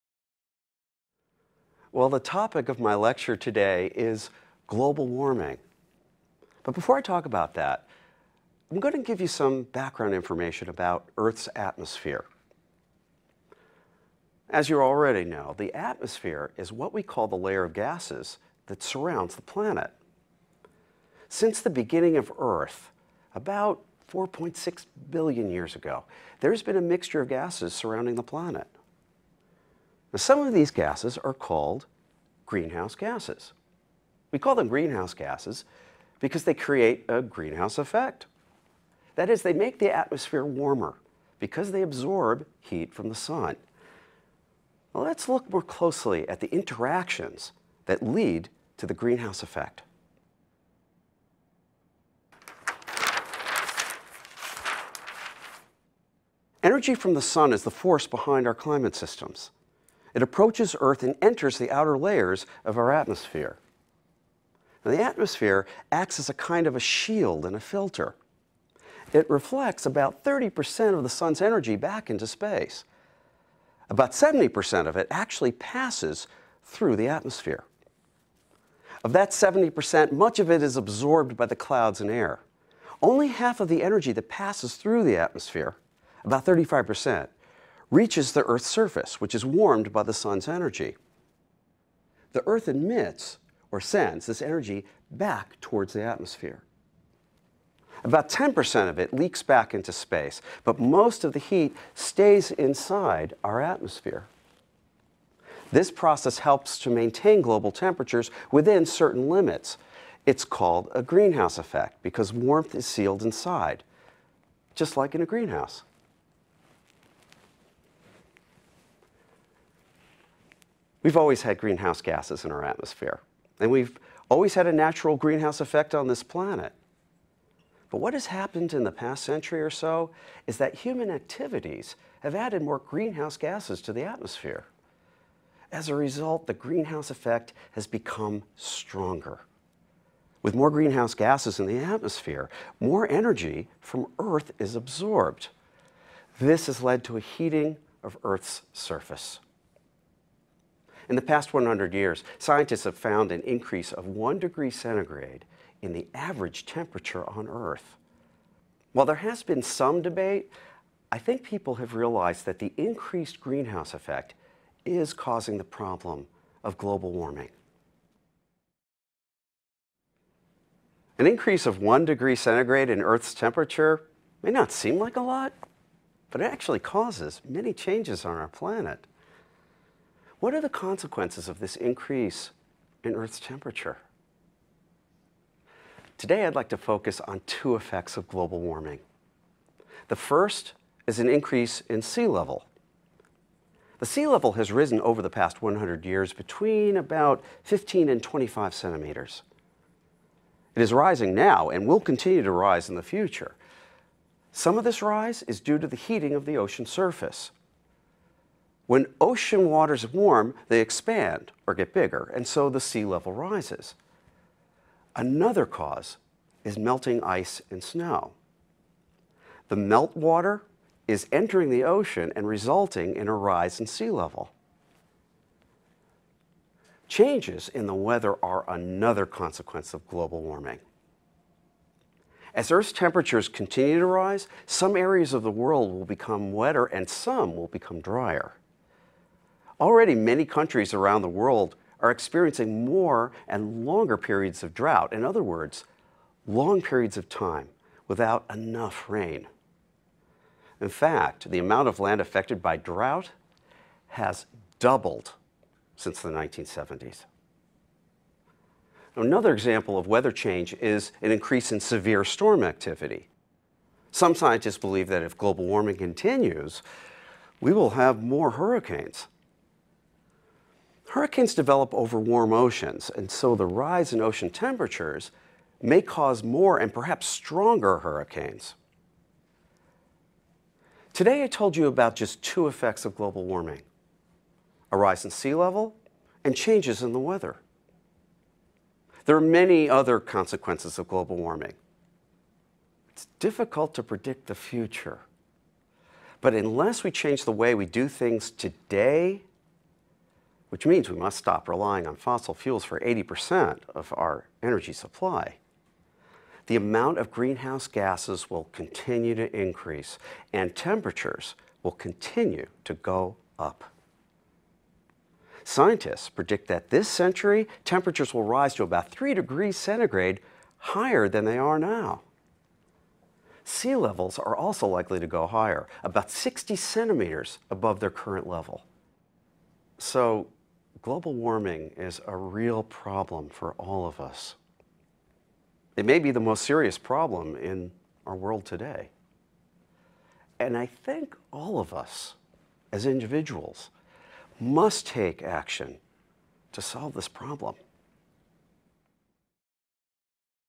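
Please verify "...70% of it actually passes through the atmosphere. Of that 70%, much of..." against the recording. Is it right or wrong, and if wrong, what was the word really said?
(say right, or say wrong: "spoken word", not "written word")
right.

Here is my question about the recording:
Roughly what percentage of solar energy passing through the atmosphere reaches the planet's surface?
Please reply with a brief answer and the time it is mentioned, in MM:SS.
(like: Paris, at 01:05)
35%, at 01:26.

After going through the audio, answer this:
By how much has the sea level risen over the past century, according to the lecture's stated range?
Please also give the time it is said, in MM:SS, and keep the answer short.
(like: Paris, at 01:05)
15 to 25 centimeters, at 03:17.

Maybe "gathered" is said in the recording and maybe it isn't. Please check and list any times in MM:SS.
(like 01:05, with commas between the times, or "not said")
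not said.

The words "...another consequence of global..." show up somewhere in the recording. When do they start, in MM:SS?
03:48.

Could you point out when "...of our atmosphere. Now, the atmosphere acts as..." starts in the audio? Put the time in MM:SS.
01:02.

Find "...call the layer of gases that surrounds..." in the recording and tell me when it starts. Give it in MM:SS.
00:17.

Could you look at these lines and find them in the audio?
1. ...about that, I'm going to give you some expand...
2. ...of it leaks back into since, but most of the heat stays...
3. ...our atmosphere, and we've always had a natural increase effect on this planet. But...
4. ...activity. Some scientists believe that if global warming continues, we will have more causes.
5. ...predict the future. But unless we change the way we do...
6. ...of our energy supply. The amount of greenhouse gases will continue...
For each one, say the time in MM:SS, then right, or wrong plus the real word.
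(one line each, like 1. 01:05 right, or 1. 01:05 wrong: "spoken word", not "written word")
1. 00:07 wrong: "background", not "expand"
2. 01:38 wrong: "space", not "since"
3. 02:02 wrong: "greenhouse", not "increase"
4. 04:22 wrong: "hurricanes", not "causes"
5. 04:54 right
6. 05:03 right.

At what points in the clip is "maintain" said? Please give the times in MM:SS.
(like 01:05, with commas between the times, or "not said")
01:46.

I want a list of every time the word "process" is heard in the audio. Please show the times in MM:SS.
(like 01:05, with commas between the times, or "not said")
01:45.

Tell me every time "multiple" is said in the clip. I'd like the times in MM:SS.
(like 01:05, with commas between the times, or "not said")
not said.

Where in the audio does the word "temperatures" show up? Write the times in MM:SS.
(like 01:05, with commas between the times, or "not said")
01:47, 02:36, 02:53, 03:03, 03:52, 04:34, 05:10, 05:17.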